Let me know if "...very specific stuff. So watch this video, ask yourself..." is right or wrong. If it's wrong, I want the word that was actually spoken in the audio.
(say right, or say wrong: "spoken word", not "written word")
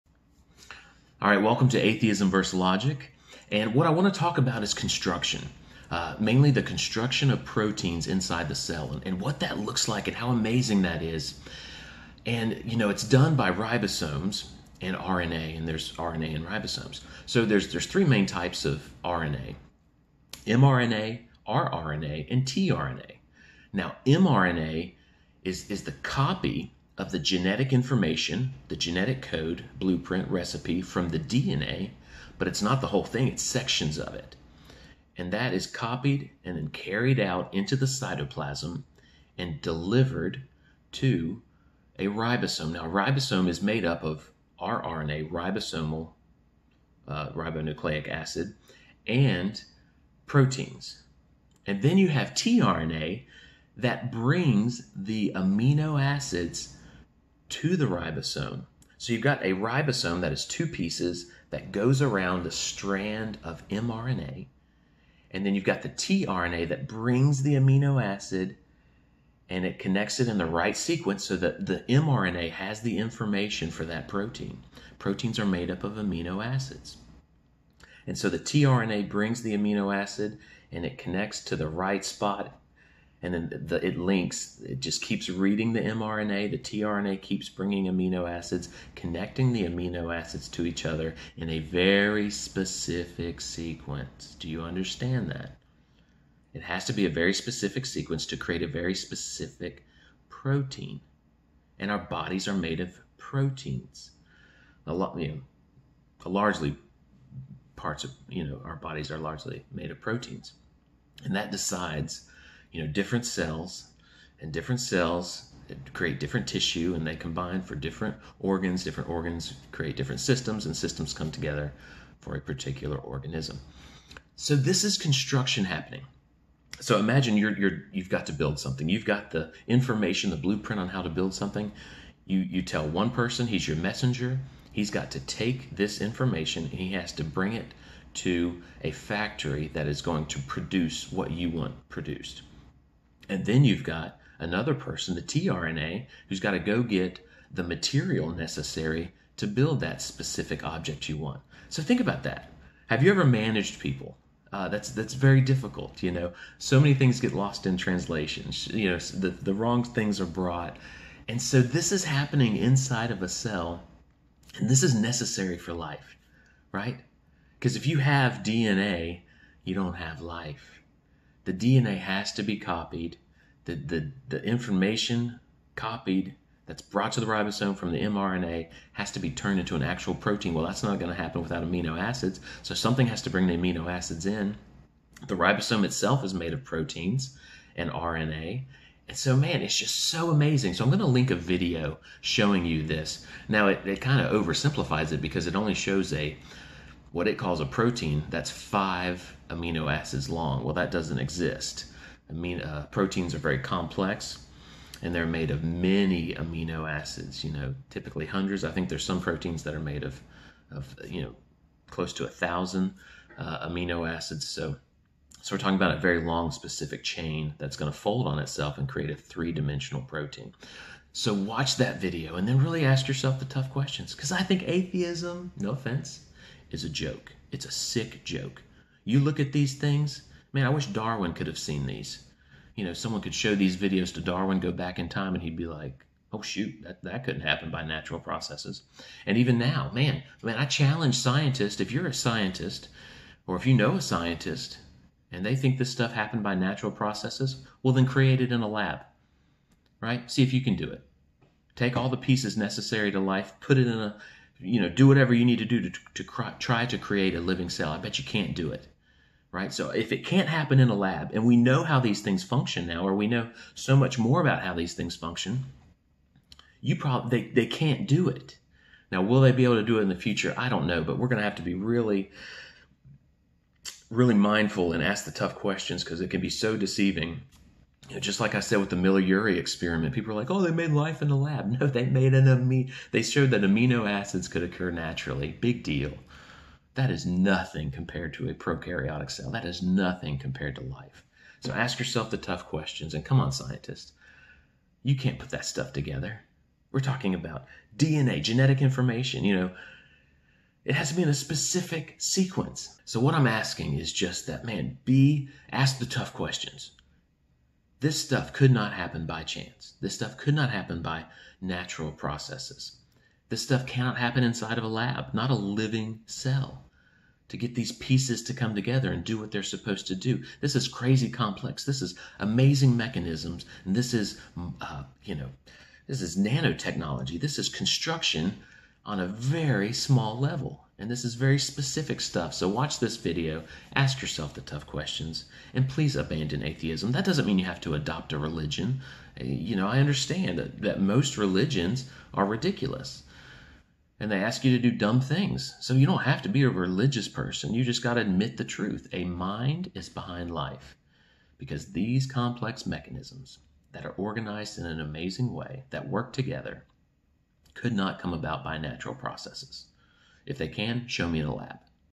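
right.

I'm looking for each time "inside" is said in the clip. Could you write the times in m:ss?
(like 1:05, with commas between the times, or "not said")
0:08, 2:42, 5:14.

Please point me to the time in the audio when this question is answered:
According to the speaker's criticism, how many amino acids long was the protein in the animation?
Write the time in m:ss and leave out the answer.
3:18.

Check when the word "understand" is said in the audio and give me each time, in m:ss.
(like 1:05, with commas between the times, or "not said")
1:34, 5:39.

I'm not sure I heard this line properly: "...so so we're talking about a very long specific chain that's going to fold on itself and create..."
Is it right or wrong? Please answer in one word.
right.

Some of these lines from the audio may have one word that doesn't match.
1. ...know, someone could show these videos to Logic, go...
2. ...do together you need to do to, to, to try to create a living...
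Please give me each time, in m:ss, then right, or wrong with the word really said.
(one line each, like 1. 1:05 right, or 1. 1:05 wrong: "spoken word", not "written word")
1. 3:52 wrong: "Darwin", not "Logic"
2. 4:14 wrong: "whatever", not "together".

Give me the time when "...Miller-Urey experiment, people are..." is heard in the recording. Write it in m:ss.
4:38.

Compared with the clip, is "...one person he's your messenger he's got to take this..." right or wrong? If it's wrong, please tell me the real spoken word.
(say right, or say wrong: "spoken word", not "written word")
right.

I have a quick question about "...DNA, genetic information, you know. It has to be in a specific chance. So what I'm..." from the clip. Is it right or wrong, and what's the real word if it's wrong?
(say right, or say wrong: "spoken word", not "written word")
wrong: "sequence", not "chance".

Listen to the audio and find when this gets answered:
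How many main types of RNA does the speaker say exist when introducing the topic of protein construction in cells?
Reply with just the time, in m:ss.
0:17.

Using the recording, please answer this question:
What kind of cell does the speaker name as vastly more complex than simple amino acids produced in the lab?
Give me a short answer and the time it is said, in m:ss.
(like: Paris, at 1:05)
prokaryotic cell, at 4:48.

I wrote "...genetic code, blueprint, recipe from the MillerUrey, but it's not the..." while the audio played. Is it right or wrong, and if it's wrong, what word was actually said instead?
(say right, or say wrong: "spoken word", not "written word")
wrong: "DNA", not "MillerUrey".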